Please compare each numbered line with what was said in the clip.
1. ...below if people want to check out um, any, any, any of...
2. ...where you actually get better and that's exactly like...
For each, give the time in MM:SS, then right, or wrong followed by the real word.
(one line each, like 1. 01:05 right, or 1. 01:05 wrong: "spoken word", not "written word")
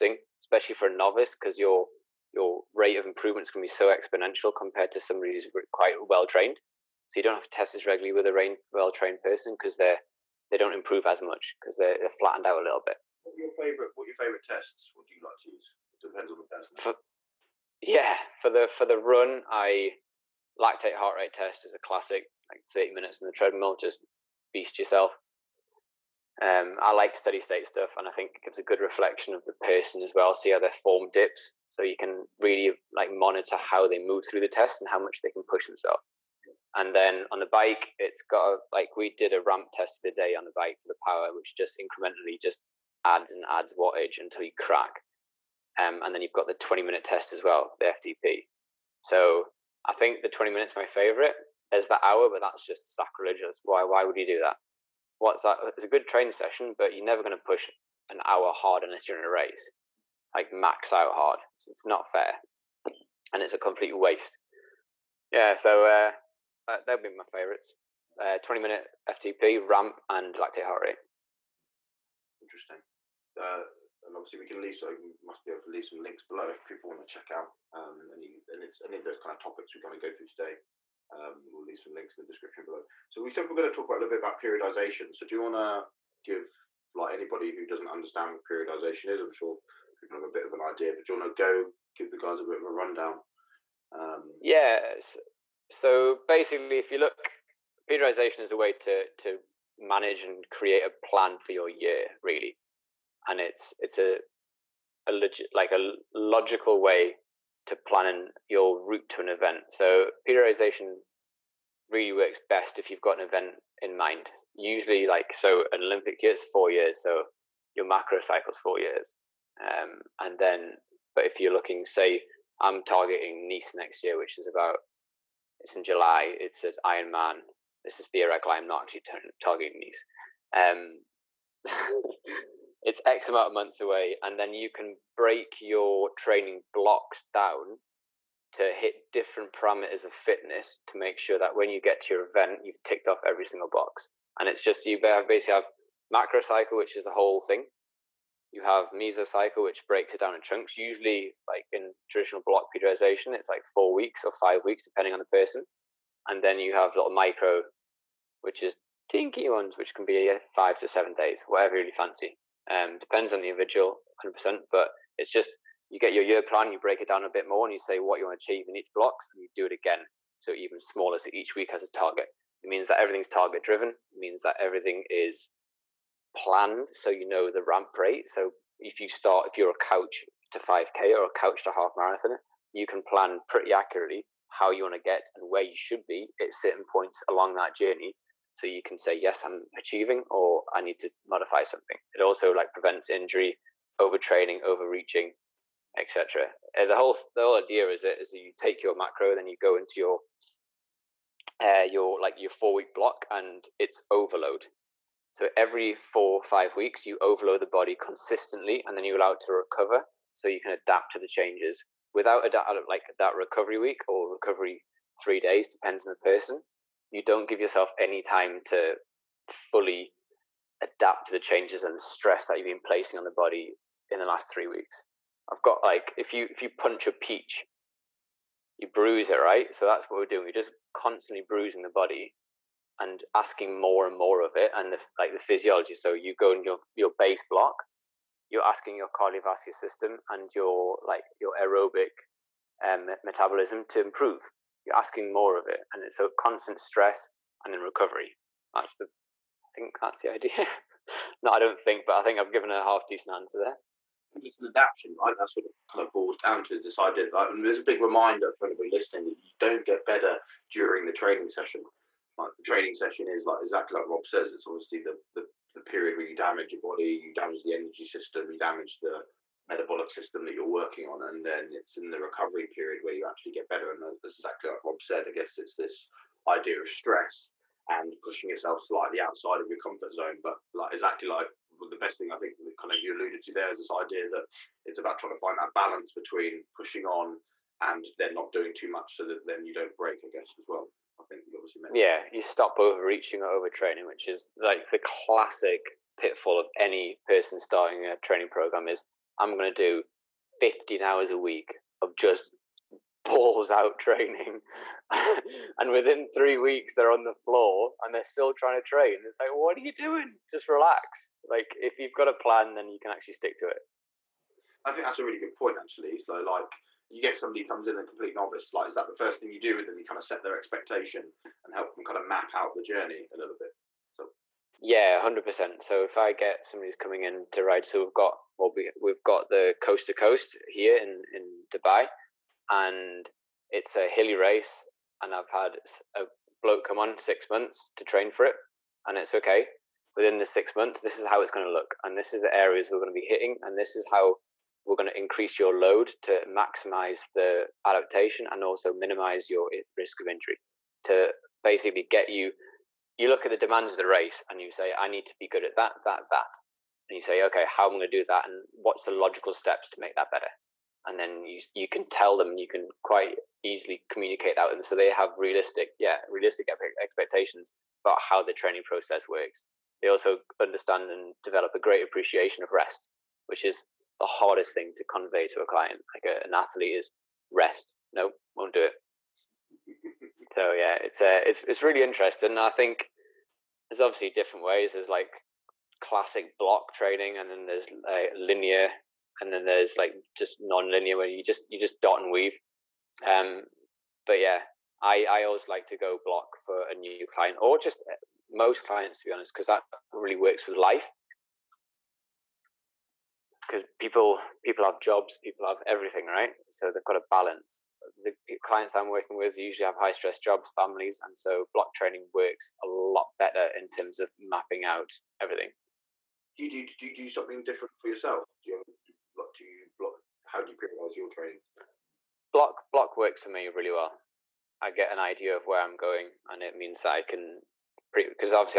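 1. 01:16 right
2. 04:33 right.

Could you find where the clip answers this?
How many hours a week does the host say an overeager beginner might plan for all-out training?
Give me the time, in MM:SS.
05:00.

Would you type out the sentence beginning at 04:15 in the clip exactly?
That's what it kind of boils down to this idea.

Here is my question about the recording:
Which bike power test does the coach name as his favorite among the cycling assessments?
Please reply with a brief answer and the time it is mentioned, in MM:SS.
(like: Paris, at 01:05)
20 minute test, at 00:50.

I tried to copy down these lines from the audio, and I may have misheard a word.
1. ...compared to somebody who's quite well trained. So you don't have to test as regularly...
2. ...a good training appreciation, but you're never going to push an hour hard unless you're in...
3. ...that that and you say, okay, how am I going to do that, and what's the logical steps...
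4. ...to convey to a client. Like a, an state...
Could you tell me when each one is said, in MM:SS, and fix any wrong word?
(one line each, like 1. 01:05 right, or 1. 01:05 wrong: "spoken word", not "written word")
1. 00:04 right
2. 00:55 wrong: "session", not "appreciation"
3. 05:56 right
4. 06:14 wrong: "athlete", not "state".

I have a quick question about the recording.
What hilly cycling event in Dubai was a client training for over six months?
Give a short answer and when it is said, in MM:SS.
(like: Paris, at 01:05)
Coast to coast, at 05:29.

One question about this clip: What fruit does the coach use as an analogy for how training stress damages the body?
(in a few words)
Peach.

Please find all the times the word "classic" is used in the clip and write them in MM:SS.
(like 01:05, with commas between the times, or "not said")
00:21, 04:54, 06:26.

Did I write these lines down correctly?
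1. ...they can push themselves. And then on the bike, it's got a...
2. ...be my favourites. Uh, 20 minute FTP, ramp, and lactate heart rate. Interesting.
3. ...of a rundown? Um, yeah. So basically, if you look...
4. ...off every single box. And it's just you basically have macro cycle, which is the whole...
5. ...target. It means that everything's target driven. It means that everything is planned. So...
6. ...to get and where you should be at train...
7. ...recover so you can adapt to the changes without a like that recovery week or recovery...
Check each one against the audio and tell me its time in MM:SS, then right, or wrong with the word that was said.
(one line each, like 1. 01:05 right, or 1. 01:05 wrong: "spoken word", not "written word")
1. 00:35 right
2. 01:06 right
3. 01:32 right
4. 02:23 right
5. 02:51 right
6. 03:04 wrong: "certain", not "train"
7. 03:29 right.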